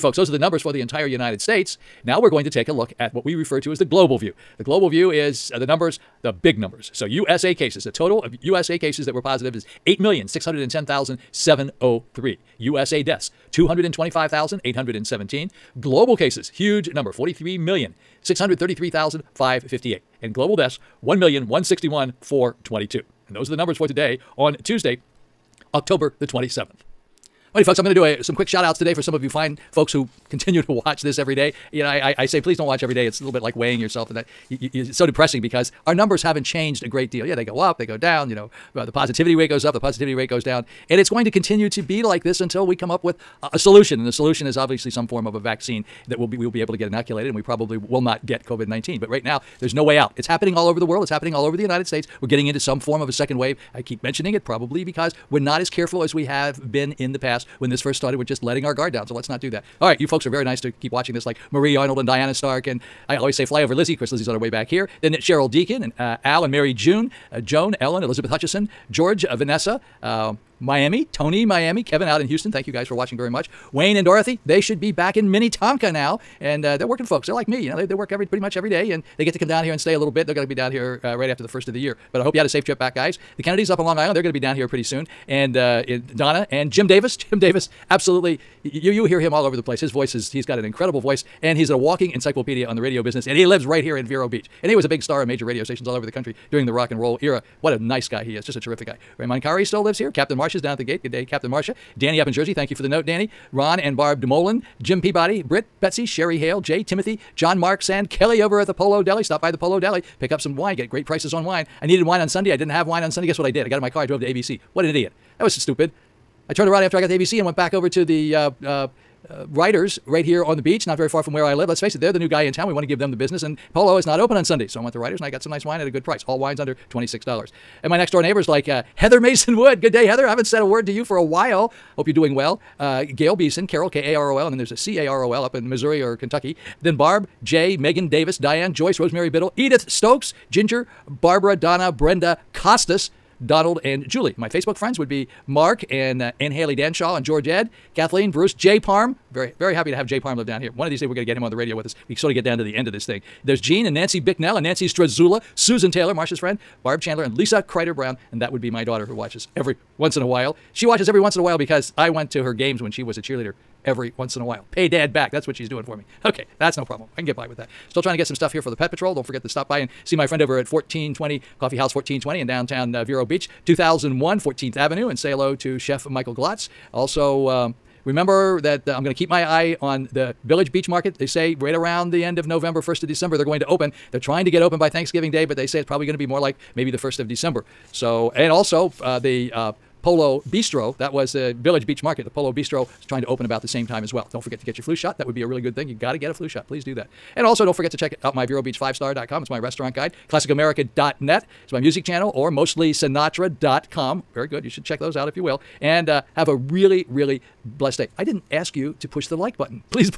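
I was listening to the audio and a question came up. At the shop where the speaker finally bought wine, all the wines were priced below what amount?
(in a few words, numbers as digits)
$26.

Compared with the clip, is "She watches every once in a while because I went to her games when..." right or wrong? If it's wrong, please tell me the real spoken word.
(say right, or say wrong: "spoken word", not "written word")
right.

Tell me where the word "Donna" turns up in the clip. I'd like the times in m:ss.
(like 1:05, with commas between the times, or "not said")
1:26, 2:21.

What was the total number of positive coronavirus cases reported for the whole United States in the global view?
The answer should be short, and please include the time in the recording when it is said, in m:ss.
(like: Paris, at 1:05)
8,610,703, at 0:09.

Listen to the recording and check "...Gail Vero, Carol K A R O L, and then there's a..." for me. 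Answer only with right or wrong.
wrong.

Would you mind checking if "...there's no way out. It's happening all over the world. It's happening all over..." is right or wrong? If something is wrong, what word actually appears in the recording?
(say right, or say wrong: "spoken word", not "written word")
right.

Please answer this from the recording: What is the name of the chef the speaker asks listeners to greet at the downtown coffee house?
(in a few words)
Michael Glotz.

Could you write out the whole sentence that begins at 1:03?
Of course, Lizzie's on her way back here.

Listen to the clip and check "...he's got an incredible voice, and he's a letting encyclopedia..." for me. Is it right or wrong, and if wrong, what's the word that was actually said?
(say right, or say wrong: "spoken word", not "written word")
wrong: "walking", not "letting".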